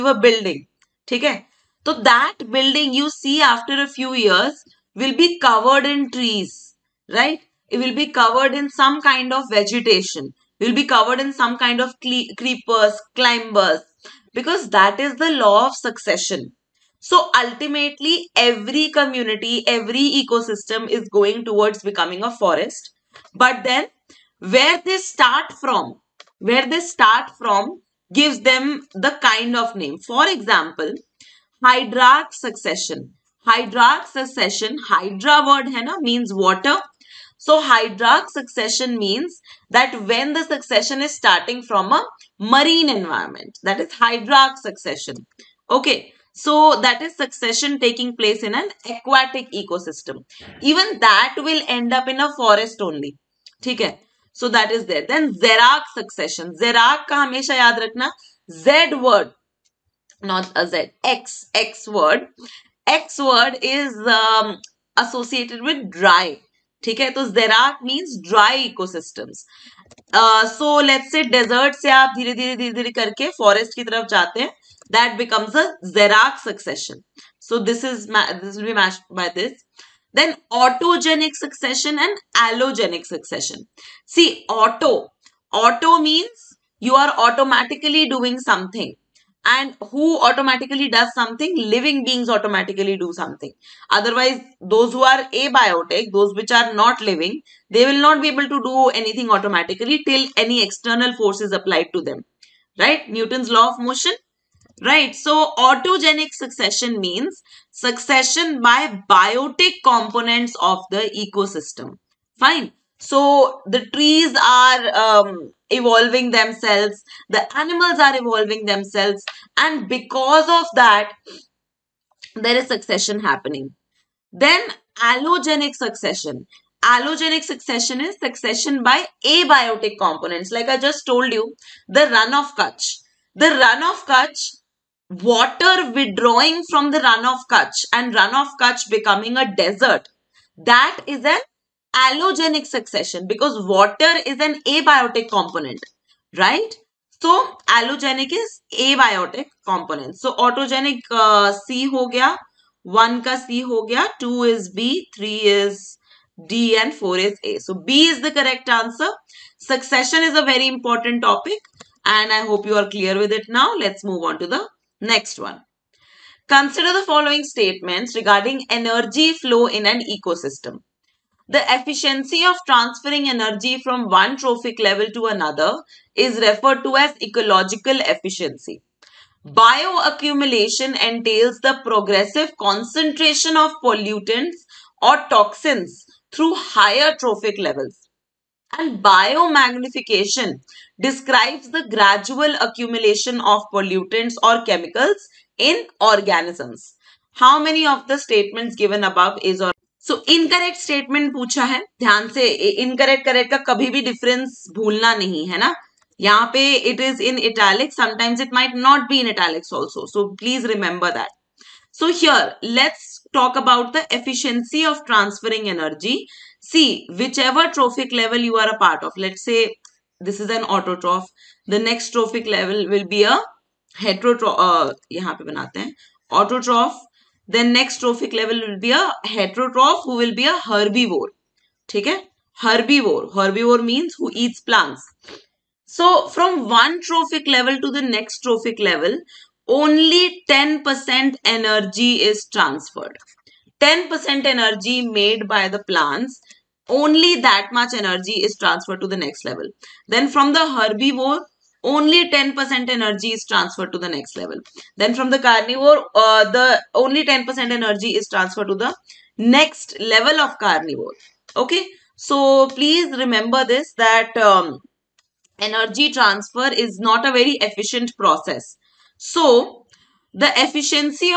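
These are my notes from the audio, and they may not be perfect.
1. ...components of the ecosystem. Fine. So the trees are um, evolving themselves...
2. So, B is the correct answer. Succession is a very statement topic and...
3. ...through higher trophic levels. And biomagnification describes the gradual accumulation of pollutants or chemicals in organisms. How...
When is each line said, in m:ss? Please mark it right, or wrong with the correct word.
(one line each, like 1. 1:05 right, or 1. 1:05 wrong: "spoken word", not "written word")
1. 1:49 right
2. 2:37 wrong: "important", not "statement"
3. 3:06 right.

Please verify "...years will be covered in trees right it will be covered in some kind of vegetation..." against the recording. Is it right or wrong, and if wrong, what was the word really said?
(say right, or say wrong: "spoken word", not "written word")
right.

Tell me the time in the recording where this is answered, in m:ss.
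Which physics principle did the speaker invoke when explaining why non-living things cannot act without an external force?
1:43.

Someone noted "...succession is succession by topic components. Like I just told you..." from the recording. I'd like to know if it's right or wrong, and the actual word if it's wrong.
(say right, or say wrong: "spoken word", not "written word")
wrong: "abiotic", not "topic".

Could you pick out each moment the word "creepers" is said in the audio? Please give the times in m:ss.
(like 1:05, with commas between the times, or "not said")
0:12.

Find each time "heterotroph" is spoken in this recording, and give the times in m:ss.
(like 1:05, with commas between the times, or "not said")
3:43, 3:49.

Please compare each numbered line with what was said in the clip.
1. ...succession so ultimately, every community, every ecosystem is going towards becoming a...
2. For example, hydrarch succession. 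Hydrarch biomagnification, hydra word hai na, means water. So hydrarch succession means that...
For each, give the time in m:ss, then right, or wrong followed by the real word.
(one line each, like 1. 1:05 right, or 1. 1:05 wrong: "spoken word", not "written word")
1. 0:15 right
2. 0:29 wrong: "succession", not "biomagnification".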